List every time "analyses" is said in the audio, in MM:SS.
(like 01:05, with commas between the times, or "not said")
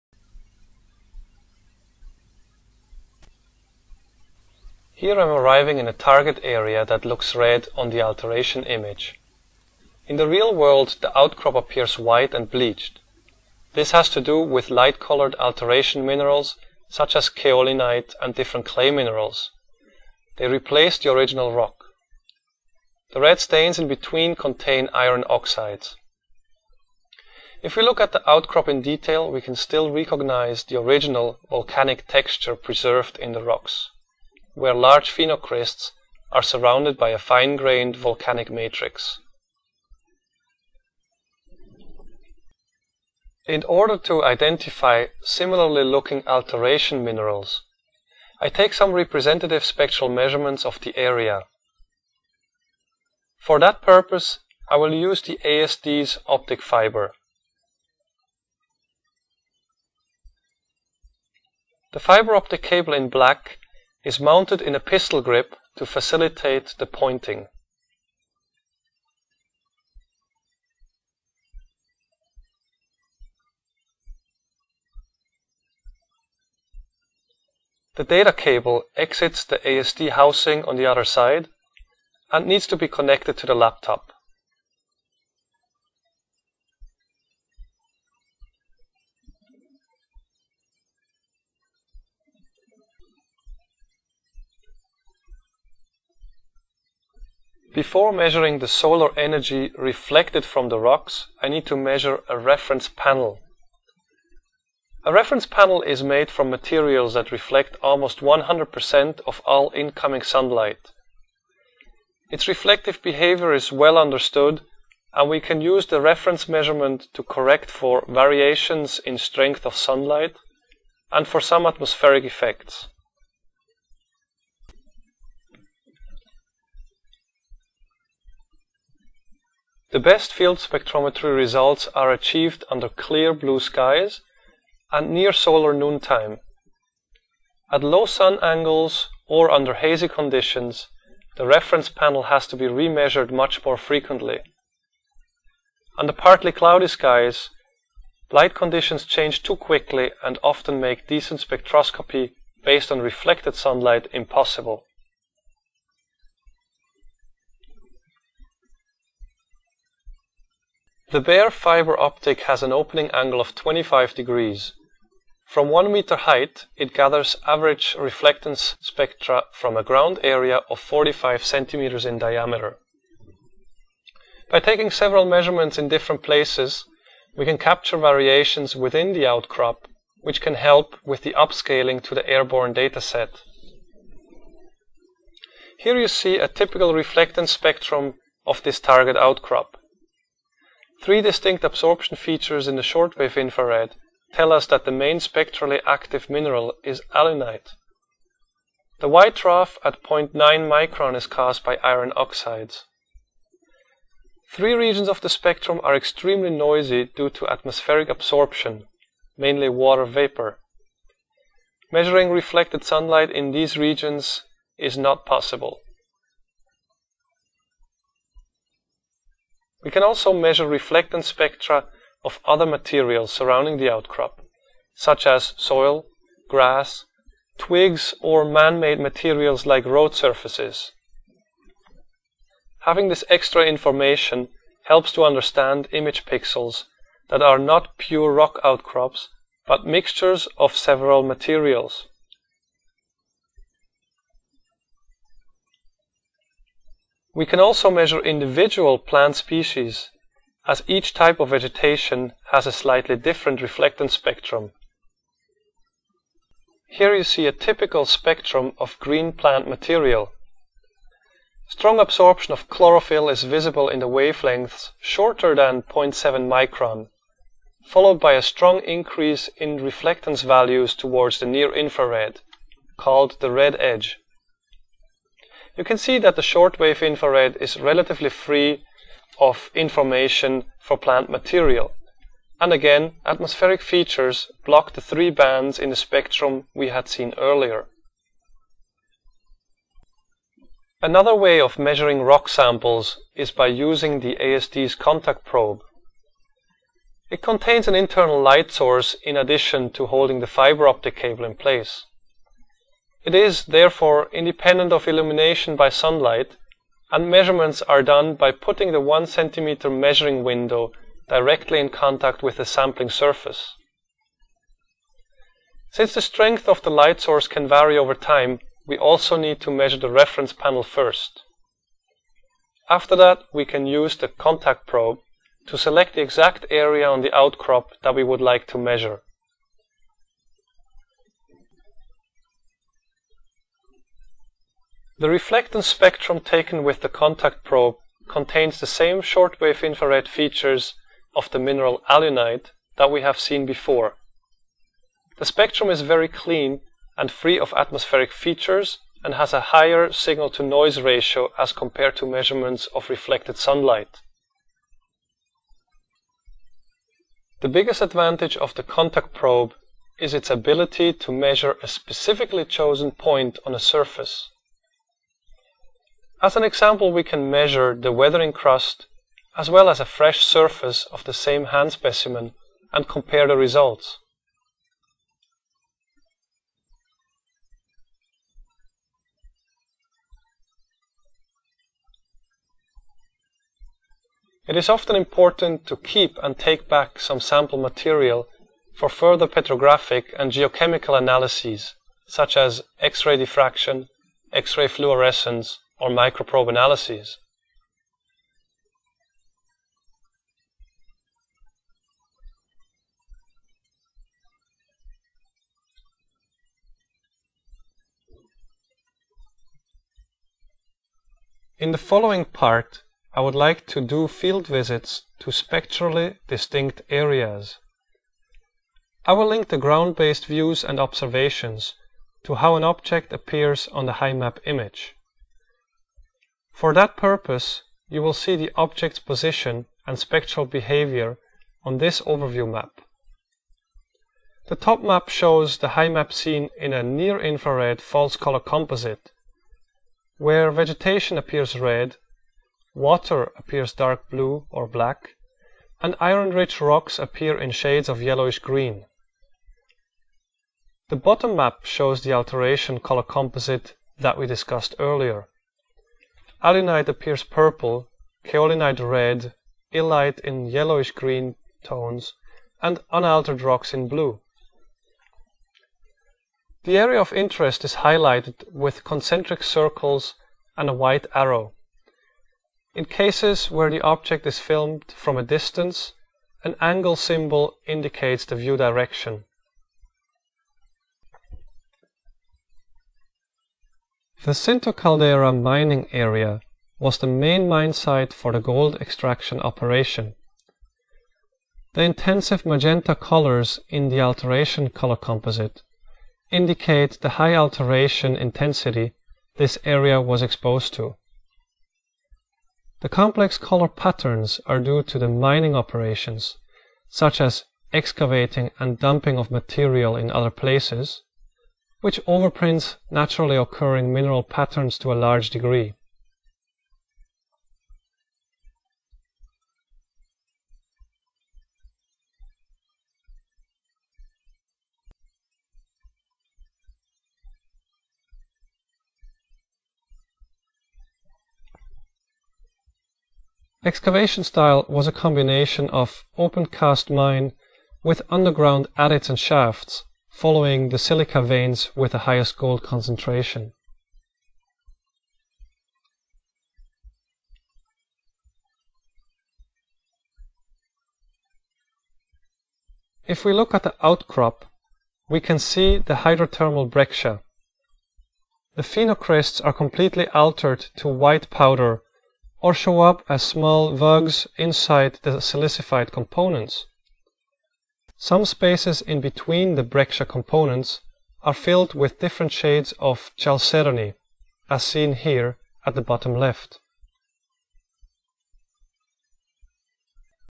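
06:31, 06:36.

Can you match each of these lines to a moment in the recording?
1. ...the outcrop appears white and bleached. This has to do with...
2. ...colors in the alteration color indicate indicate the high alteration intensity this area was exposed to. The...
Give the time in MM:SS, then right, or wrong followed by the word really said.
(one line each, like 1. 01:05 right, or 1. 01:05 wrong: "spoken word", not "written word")
1. 00:11 right
2. 08:13 wrong: "composite", not "indicate".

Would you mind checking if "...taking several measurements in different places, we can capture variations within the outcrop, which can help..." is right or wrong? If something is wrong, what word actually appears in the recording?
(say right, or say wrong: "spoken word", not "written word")
right.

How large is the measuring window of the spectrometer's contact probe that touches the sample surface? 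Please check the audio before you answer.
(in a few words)
1 cm.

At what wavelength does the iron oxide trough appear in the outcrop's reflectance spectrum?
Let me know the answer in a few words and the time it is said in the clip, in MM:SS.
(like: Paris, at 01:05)
0.9 micron, at 03:20.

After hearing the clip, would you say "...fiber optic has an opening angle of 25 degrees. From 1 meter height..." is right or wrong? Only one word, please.
right.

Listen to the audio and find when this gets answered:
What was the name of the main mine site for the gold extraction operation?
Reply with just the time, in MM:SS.
08:04.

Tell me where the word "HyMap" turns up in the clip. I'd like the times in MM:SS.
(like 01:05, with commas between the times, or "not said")
07:04, 07:15.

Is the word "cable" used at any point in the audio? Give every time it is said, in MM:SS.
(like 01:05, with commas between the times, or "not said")
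01:02, 01:18, 05:01.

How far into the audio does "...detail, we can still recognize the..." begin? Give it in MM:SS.
00:28.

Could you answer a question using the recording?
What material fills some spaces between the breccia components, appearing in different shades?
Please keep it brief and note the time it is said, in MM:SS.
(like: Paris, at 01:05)
Chalcedony, at 09:33.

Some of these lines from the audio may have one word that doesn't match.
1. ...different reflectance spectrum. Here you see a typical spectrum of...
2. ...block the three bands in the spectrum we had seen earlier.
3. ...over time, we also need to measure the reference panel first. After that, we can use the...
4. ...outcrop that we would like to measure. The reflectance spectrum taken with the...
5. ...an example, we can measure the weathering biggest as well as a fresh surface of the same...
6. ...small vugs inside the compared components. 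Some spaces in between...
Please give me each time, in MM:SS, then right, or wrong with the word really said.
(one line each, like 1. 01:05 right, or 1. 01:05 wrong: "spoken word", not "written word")
1. 04:13 right
2. 04:44 right
3. 05:17 right
4. 05:27 right
5. 06:06 wrong: "crust", not "biggest"
6. 09:23 wrong: "silicified", not "compared".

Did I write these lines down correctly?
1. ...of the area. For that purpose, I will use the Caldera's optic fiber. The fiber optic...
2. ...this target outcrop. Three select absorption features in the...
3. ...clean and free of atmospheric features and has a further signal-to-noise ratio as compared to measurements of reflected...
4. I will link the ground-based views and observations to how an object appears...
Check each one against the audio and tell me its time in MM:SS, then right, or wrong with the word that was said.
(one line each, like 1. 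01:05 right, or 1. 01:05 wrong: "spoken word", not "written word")
1. 00:50 wrong: "ASD", not "Caldera"
2. 03:08 wrong: "distinct", not "select"
3. 05:46 wrong: "higher", not "further"
4. 06:59 right.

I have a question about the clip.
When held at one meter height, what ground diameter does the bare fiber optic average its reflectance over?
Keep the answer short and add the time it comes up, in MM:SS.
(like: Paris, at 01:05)
45 centimeters, at 02:50.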